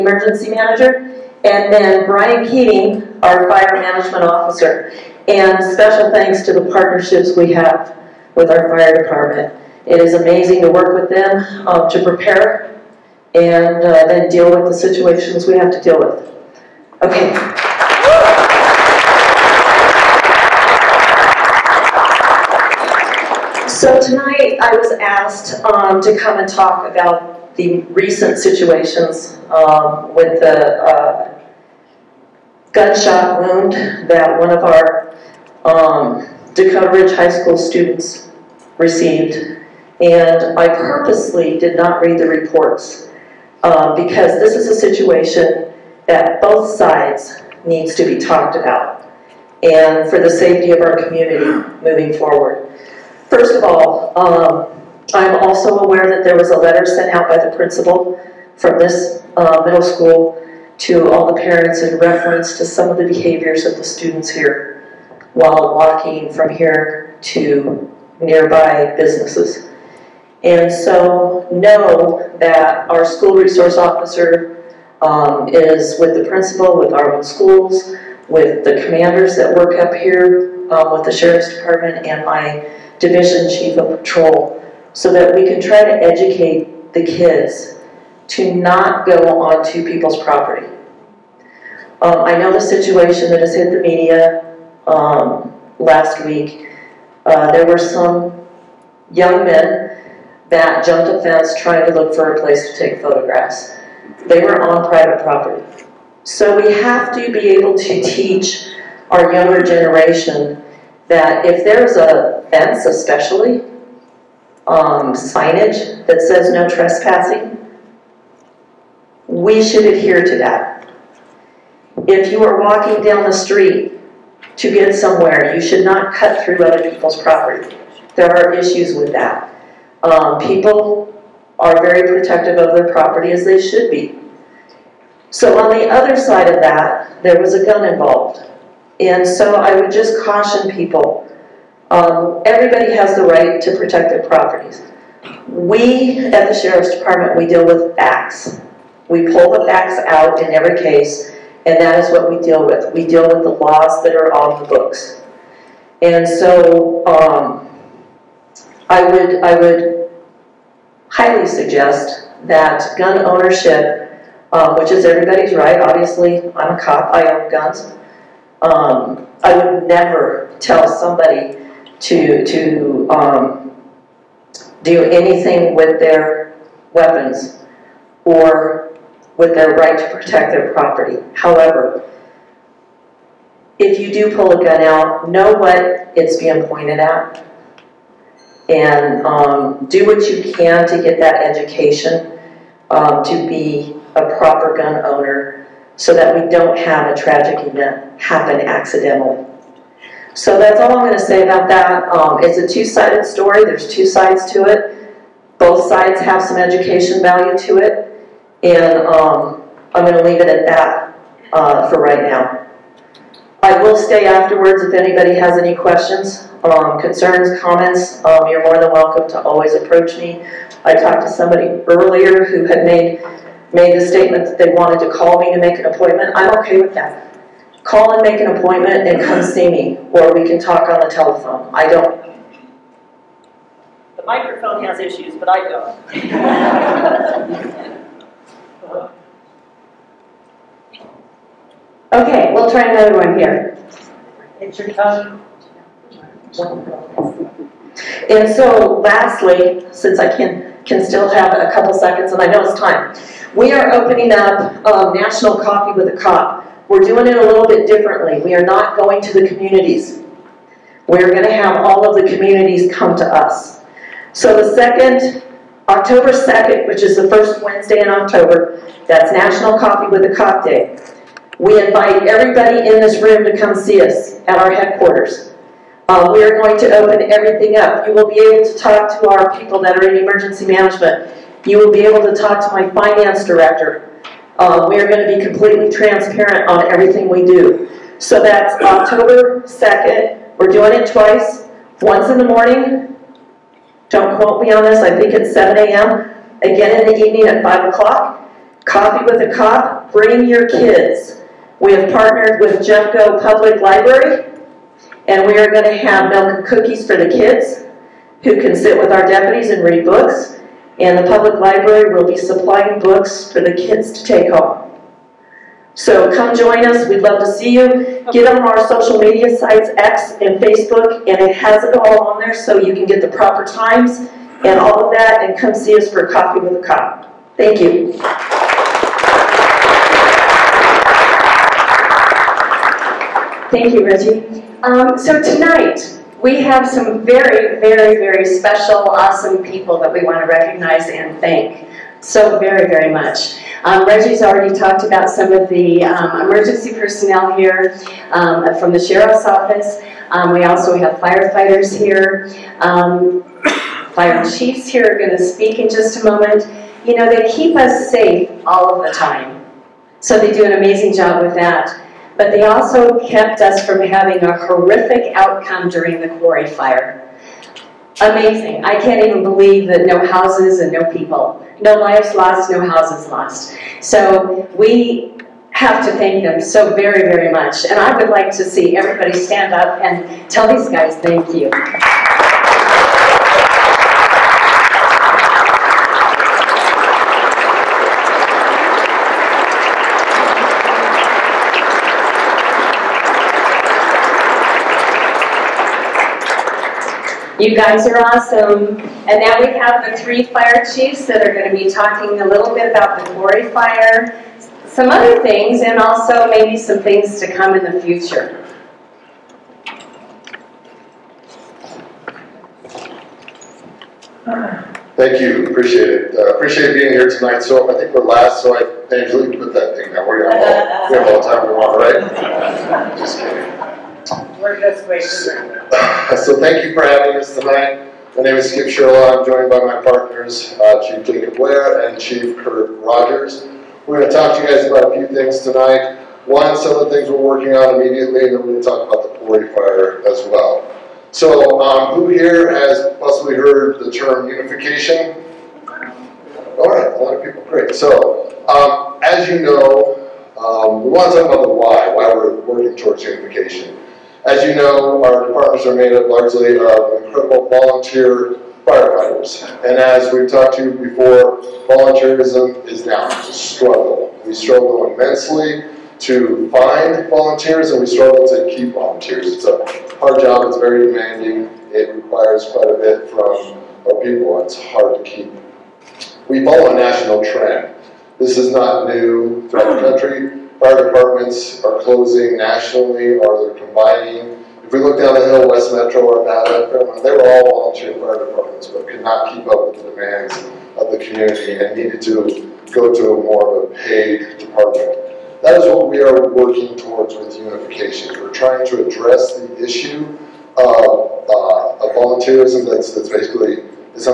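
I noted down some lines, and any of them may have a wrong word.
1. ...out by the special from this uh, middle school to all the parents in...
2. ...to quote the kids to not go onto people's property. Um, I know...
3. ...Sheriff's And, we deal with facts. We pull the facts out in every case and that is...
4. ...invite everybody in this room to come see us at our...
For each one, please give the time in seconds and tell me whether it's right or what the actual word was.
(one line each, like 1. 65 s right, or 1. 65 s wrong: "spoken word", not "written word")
1. 57 s wrong: "principal", not "special"
2. 85 s wrong: "educate", not "quote"
3. 146 s wrong: "Department", not "And"
4. 271 s right.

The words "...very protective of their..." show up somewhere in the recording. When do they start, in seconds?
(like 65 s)
131 s.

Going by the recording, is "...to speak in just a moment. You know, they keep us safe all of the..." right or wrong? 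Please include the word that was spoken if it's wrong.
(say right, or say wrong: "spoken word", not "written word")
right.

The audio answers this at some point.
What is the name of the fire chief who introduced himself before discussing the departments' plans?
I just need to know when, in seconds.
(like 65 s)
428 s.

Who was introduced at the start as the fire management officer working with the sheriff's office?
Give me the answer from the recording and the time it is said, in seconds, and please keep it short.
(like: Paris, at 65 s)
Brian Keating, at 2 s.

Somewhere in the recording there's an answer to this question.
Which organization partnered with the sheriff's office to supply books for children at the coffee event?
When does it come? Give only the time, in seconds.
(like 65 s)
302 s.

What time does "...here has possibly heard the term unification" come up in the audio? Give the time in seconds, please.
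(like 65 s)
442 s.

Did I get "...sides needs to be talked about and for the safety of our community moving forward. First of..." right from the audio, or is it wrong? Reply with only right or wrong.
right.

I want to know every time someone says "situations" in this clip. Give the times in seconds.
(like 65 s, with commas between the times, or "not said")
14 s, 28 s, 44 s, 92 s.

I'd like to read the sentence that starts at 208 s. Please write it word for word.
And um, I'm going to leave it at that uh, for right now.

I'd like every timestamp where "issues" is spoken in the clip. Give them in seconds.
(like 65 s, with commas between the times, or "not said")
128 s, 234 s, 499 s.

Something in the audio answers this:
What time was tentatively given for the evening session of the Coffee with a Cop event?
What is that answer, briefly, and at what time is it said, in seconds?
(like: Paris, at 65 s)
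5 o'clock, at 297 s.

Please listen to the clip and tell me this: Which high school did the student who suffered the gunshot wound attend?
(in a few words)
Dakota Ridge High School.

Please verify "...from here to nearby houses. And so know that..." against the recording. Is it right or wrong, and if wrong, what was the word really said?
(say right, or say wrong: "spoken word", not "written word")
wrong: "businesses", not "houses".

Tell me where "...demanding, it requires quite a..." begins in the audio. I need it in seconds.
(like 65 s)
471 s.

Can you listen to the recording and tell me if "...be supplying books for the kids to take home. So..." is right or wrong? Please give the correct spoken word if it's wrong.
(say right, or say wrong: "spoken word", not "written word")
right.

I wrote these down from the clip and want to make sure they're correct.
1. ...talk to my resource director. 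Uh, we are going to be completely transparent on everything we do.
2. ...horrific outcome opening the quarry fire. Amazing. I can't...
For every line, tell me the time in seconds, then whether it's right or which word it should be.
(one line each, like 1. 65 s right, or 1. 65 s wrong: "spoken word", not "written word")
1. 282 s wrong: "finance", not "resource"
2. 364 s wrong: "during", not "opening".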